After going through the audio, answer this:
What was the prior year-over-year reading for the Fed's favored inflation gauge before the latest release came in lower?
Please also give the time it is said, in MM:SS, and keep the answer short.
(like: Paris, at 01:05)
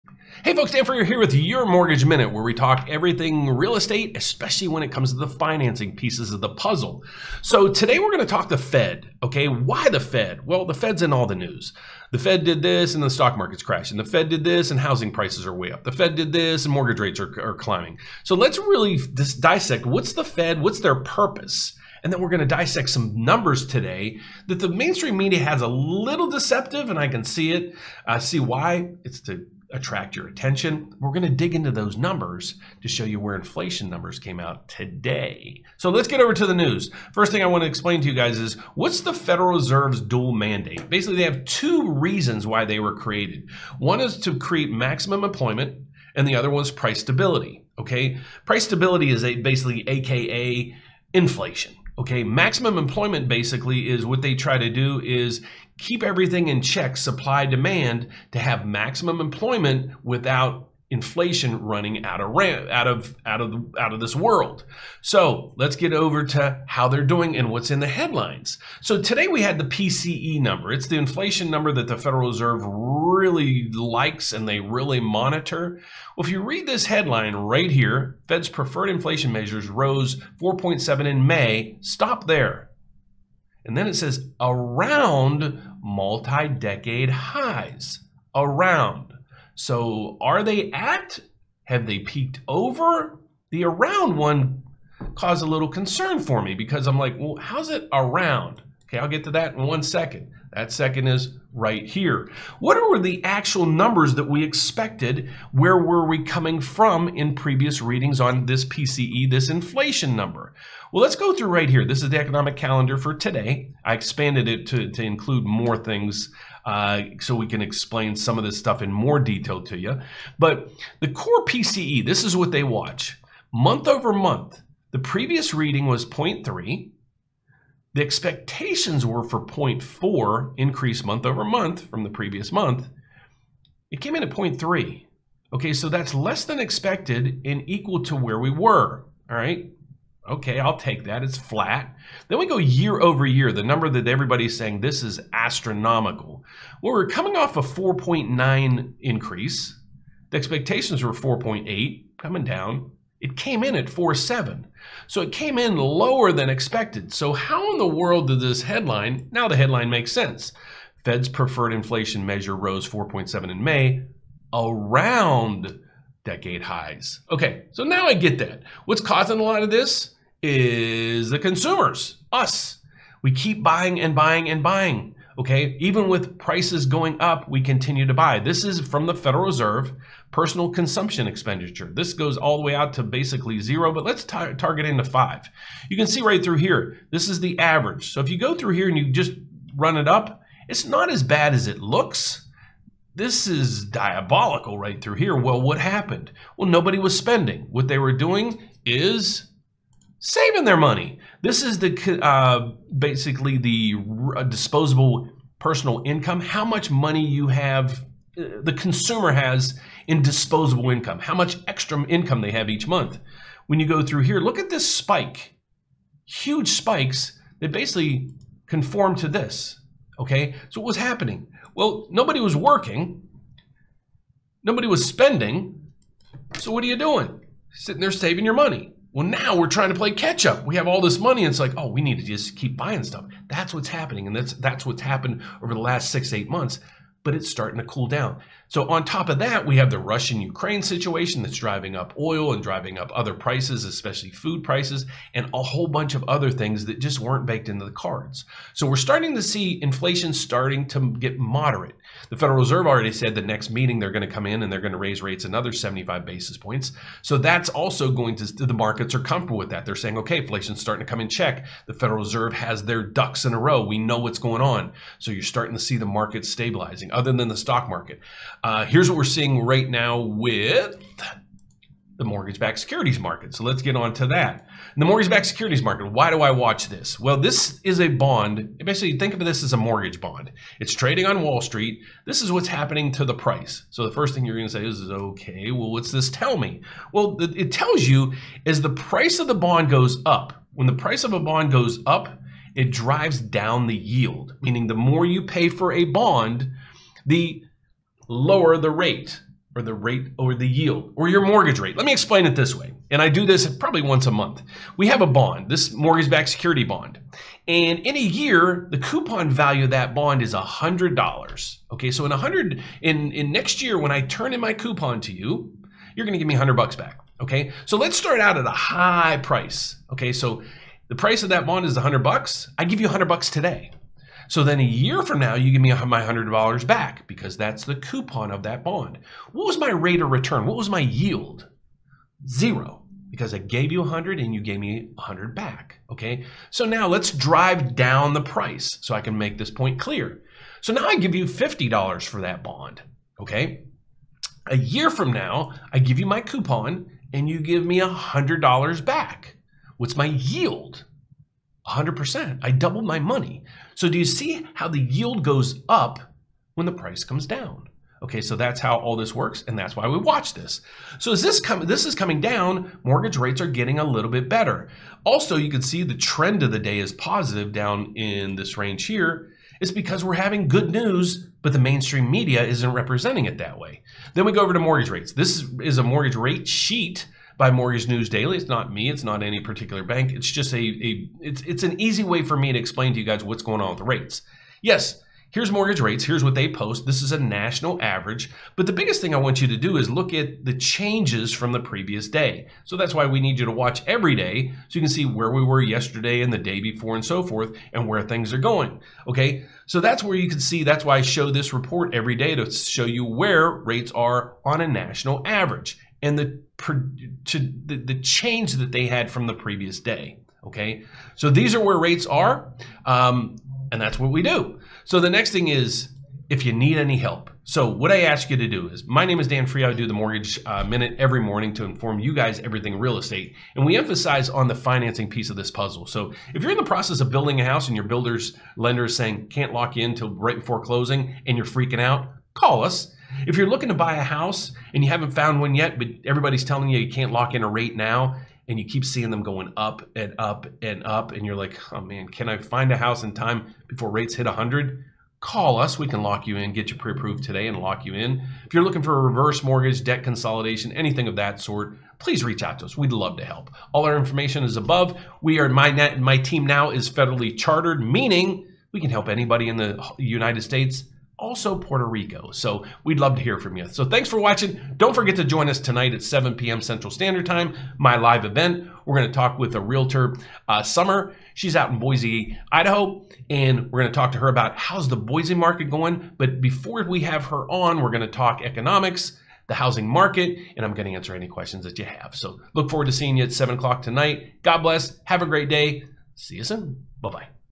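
4.9, at 02:27.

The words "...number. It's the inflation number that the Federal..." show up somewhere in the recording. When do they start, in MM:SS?
01:10.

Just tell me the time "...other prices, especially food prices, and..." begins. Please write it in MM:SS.
04:03.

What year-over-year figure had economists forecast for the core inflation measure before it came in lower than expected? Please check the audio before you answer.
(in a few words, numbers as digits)
4.8.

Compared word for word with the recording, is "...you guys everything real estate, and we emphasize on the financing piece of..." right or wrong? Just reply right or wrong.
right.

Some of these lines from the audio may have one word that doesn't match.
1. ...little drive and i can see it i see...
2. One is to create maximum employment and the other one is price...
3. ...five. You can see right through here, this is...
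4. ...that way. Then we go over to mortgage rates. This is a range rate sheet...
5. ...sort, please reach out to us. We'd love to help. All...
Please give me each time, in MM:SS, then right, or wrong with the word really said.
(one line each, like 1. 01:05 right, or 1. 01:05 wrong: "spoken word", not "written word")
1. 00:25 wrong: "deceptive", not "drive"
2. 00:43 right
3. 03:05 right
4. 06:13 wrong: "mortgage", not "range"
5. 07:31 right.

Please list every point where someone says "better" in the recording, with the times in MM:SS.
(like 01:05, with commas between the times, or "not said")
06:04.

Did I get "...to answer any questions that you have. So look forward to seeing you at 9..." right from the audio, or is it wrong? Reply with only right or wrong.
wrong.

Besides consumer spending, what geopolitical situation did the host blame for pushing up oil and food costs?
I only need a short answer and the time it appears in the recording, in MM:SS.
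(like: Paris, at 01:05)
Russian Ukraine situation, at 03:59.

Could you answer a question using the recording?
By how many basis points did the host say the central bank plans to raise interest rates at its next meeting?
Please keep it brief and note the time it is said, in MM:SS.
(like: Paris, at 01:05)
75, at 04:15.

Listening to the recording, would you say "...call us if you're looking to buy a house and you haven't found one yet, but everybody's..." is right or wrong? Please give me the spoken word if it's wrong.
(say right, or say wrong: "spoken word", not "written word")
right.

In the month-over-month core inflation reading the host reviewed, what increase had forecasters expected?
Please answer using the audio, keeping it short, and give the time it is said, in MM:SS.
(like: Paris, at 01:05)
0.4, at 02:09.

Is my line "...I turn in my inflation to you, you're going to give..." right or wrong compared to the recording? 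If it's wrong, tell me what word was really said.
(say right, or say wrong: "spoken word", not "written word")
wrong: "coupon", not "inflation".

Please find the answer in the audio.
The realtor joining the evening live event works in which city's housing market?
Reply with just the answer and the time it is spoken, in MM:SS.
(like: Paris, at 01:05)
Boise, Idaho, at 07:51.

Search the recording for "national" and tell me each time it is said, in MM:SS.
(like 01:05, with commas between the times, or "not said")
06:27, 06:44.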